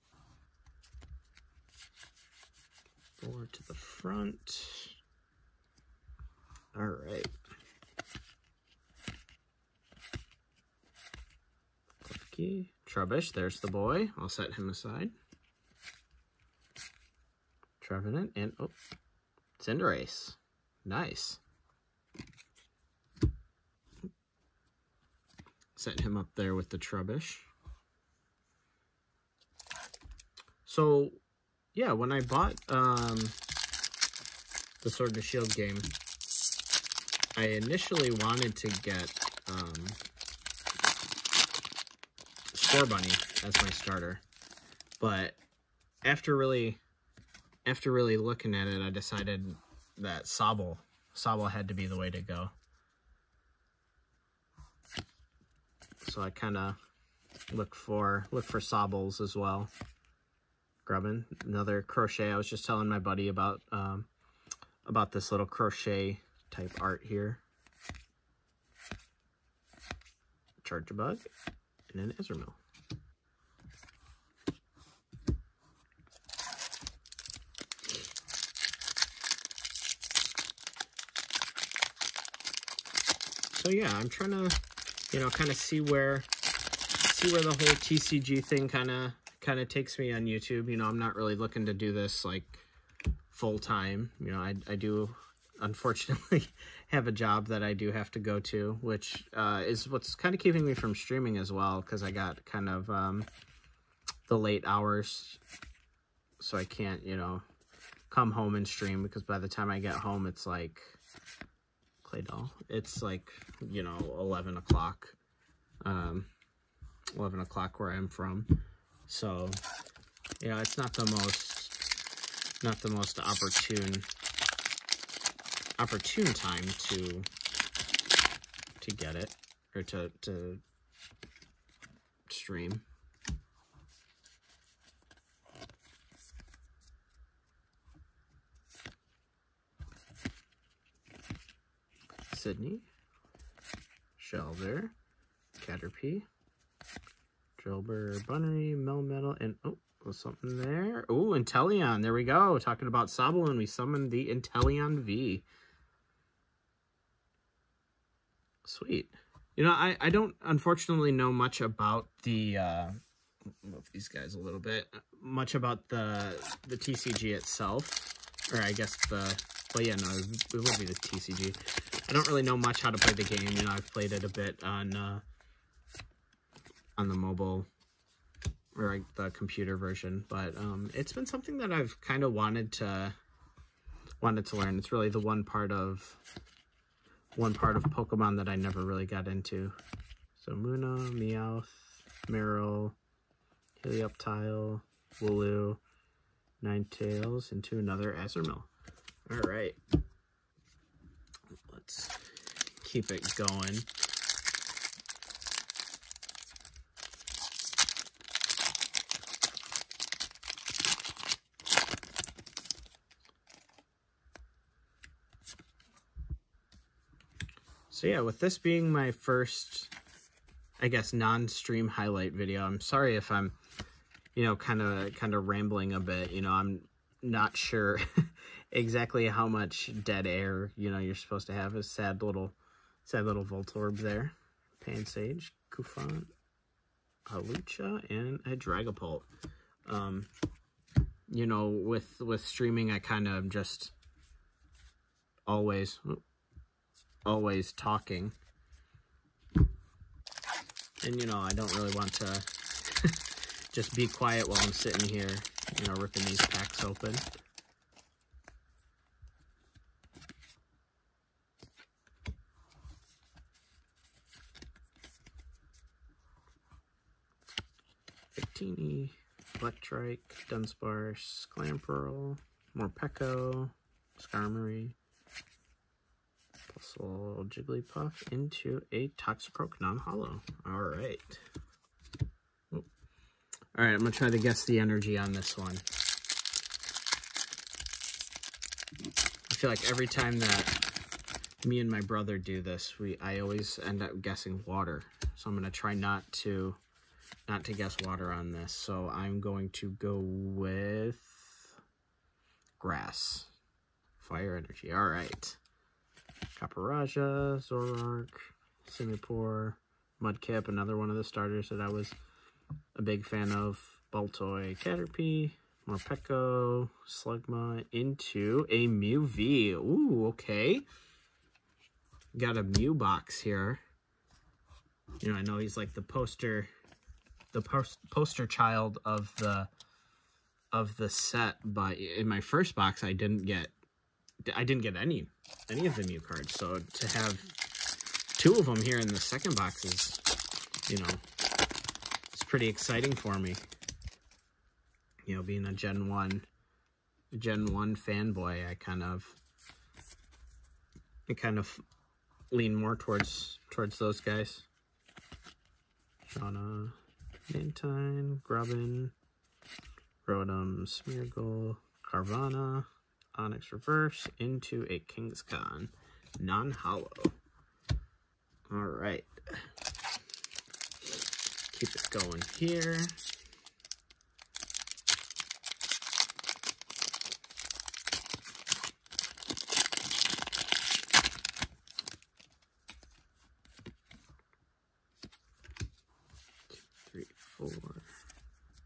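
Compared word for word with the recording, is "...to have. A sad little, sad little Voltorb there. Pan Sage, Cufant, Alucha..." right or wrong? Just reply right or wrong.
right.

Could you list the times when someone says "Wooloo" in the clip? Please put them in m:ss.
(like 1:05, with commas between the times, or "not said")
3:15.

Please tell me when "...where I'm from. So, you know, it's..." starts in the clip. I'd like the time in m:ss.
1:57.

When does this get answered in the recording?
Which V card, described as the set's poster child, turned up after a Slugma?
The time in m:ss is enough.
5:18.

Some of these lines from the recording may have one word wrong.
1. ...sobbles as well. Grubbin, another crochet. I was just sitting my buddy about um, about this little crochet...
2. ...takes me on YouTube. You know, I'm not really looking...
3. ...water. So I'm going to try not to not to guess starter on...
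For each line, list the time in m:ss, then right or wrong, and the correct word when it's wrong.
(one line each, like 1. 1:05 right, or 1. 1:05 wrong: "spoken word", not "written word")
1. 0:58 wrong: "telling", not "sitting"
2. 1:29 right
3. 4:54 wrong: "water", not "starter".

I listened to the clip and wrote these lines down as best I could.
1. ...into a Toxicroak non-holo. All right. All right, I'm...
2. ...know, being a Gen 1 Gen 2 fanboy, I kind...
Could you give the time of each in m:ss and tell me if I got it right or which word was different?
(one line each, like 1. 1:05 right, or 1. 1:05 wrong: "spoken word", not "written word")
1. 4:38 right
2. 5:45 wrong: "1", not "2".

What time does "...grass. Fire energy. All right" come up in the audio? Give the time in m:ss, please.
5:02.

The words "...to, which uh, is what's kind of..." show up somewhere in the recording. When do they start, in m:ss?
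1:38.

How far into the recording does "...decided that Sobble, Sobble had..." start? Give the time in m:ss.
0:48.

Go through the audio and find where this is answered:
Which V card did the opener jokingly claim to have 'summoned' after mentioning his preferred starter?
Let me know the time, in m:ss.
2:34.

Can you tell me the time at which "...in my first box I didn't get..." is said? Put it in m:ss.
5:31.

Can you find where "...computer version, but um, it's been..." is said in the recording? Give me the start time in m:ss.
2:59.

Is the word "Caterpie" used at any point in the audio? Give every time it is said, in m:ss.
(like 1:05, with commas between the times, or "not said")
2:25, 5:14.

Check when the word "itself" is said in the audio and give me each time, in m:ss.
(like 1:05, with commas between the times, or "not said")
2:47.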